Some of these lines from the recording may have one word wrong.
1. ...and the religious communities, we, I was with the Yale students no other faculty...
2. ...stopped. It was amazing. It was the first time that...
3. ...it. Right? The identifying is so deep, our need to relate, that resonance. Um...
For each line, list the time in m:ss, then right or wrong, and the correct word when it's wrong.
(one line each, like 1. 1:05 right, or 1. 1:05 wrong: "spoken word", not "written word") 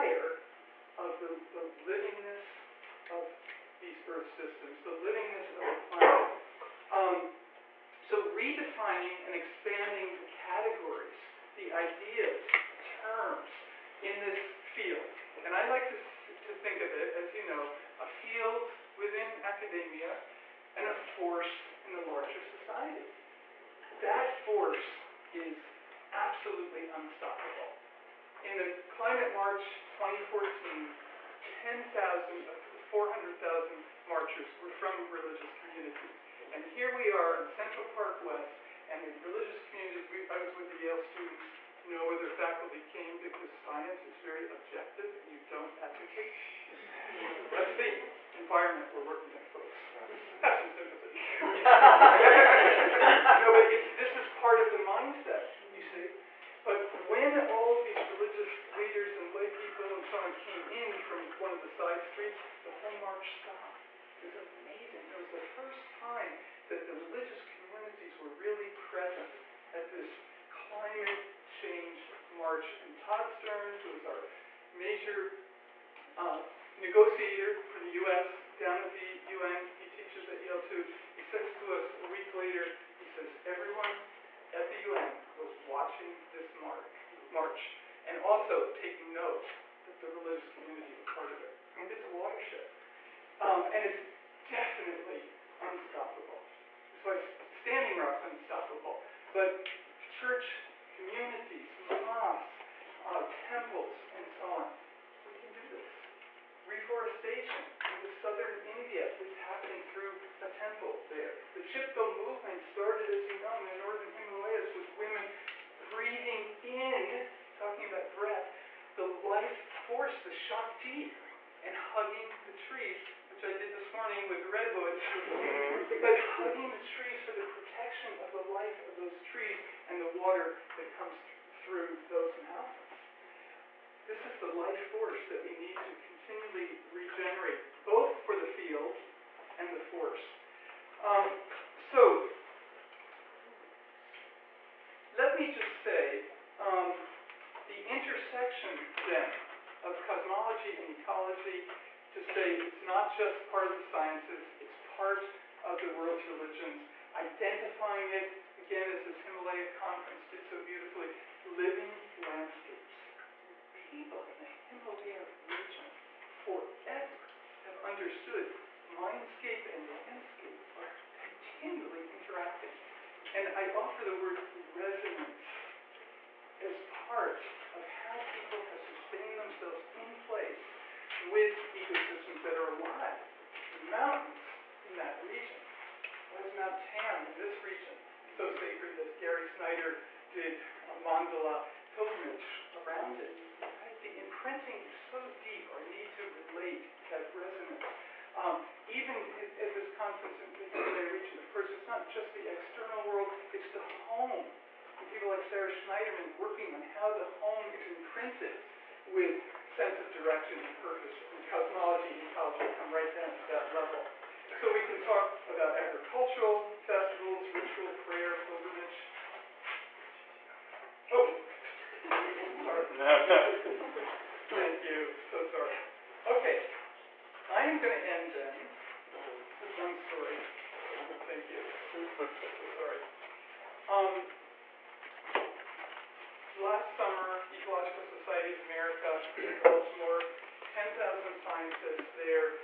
1. 0:38 right
2. 1:03 right
3. 3:13 wrong: "imprinting", not "identifying".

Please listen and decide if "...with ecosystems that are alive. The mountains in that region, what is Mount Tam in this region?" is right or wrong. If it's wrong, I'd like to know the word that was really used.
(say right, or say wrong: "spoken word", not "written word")
right.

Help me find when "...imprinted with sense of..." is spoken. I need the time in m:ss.
3:27.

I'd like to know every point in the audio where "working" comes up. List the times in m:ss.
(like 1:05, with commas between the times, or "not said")
0:49, 3:26.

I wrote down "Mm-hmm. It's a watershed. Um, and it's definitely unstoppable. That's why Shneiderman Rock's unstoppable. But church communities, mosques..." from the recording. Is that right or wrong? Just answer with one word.
wrong.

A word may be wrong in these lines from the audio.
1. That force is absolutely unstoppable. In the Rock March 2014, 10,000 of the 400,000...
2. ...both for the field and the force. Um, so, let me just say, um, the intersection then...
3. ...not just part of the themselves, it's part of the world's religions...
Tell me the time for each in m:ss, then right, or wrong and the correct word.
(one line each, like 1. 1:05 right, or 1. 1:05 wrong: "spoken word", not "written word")
1. 0:24 wrong: "Climate", not "Rock"
2. 2:17 right
3. 2:32 wrong: "sciences", not "themselves".